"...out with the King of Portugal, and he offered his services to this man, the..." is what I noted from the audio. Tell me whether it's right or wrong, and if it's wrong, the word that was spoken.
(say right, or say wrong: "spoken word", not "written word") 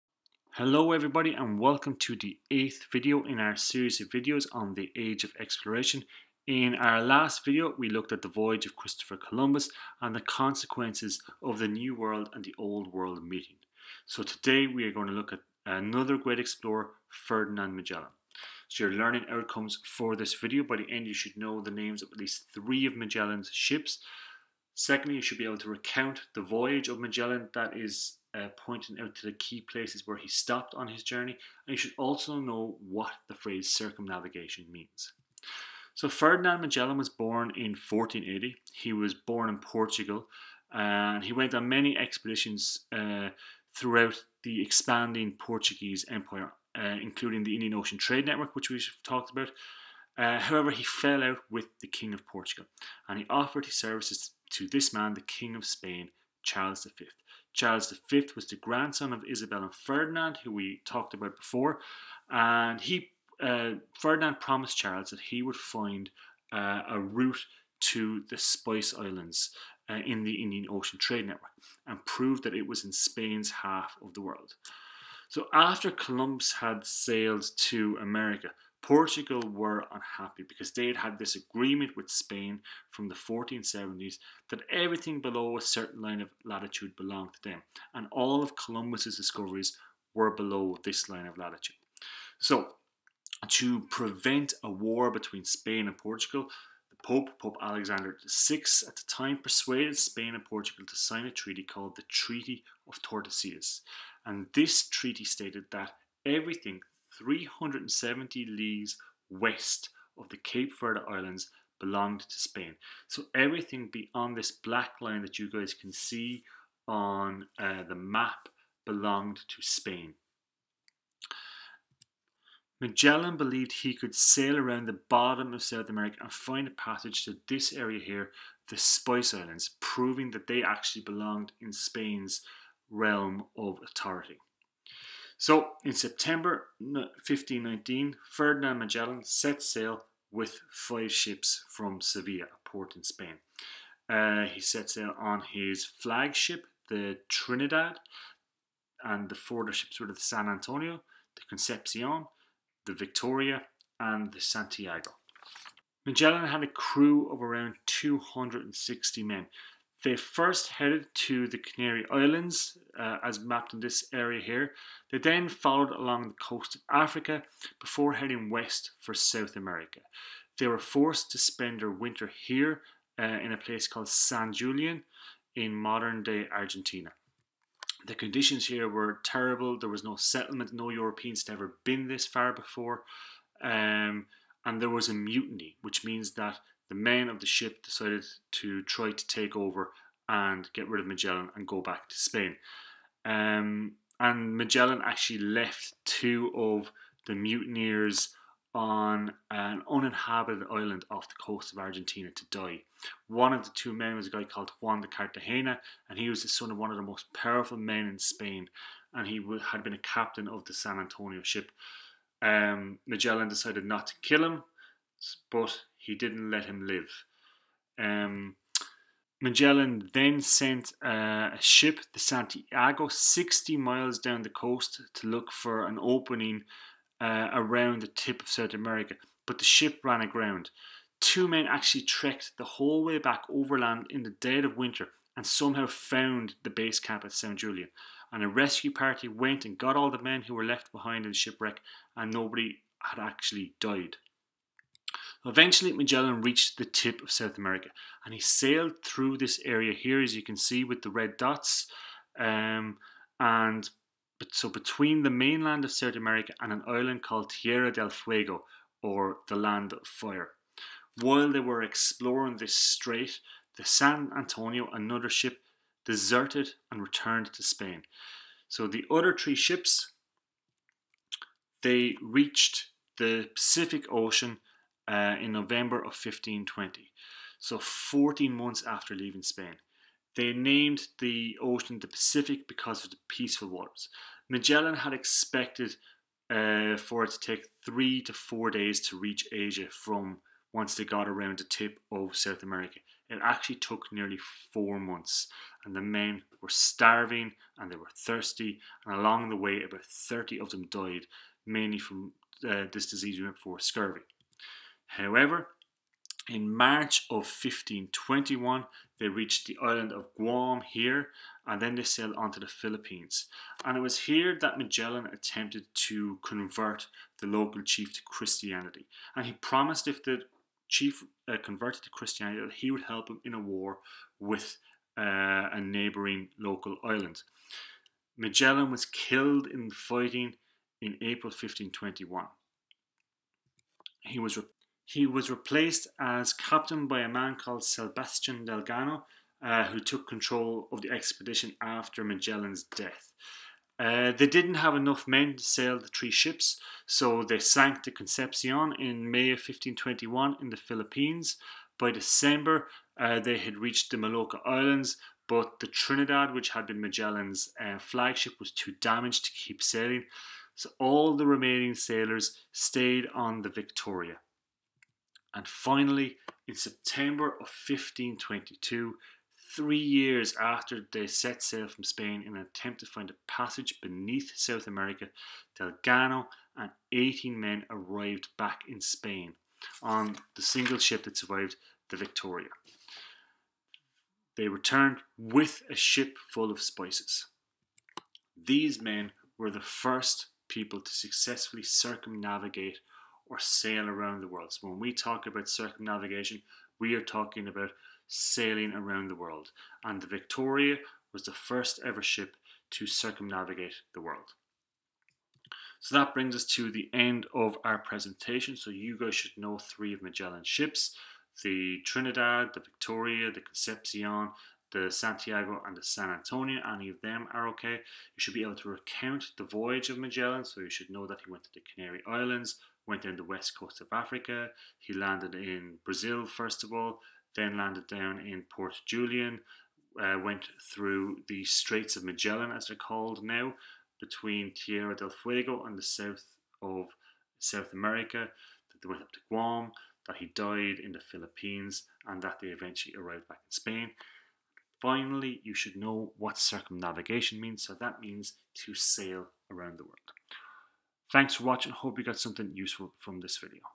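right.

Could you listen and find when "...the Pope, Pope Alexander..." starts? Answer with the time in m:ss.
1:36.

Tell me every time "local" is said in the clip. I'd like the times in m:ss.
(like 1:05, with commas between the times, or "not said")
5:17, 5:26.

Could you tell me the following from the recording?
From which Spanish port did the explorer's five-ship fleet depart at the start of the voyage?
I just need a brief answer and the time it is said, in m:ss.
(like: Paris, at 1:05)
Seville, at 2:21.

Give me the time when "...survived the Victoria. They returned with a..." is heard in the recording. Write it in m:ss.
6:21.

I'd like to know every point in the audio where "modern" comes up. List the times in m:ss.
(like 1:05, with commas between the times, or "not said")
2:55.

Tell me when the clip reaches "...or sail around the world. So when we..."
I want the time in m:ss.
6:33.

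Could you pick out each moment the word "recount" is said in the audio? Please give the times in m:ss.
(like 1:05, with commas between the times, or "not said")
0:25, 6:58.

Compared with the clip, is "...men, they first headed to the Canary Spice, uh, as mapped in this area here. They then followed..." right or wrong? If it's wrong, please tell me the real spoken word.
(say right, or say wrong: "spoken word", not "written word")
wrong: "Islands", not "Spice".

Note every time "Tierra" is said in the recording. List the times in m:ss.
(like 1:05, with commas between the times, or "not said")
4:17, 7:14.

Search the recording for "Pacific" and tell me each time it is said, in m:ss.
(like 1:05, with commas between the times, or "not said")
4:33, 4:42.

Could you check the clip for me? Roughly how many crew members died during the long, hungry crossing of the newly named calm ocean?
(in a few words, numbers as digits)
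30.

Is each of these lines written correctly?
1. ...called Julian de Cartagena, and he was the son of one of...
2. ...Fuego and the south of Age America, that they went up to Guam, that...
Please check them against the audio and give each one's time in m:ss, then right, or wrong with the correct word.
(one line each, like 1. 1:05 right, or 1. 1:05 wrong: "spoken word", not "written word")
1. 3:24 wrong: "Juan", not "Julian"
2. 7:15 wrong: "South", not "Age".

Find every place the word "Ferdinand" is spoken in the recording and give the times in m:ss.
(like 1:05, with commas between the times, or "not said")
0:17, 0:36, 0:59, 1:03, 2:18.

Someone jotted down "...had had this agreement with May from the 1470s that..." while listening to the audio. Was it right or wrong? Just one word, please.
wrong.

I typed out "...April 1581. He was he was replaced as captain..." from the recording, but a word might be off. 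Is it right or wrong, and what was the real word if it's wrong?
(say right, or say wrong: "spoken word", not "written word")
wrong: "1521", not "1581".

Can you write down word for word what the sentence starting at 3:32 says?
Um, Magellan decided not to kill him, but he didn't let him live.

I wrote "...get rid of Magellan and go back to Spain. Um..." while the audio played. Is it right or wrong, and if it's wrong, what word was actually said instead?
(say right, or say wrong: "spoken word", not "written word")
right.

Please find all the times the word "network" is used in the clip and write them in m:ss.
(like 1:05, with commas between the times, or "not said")
0:48, 1:11.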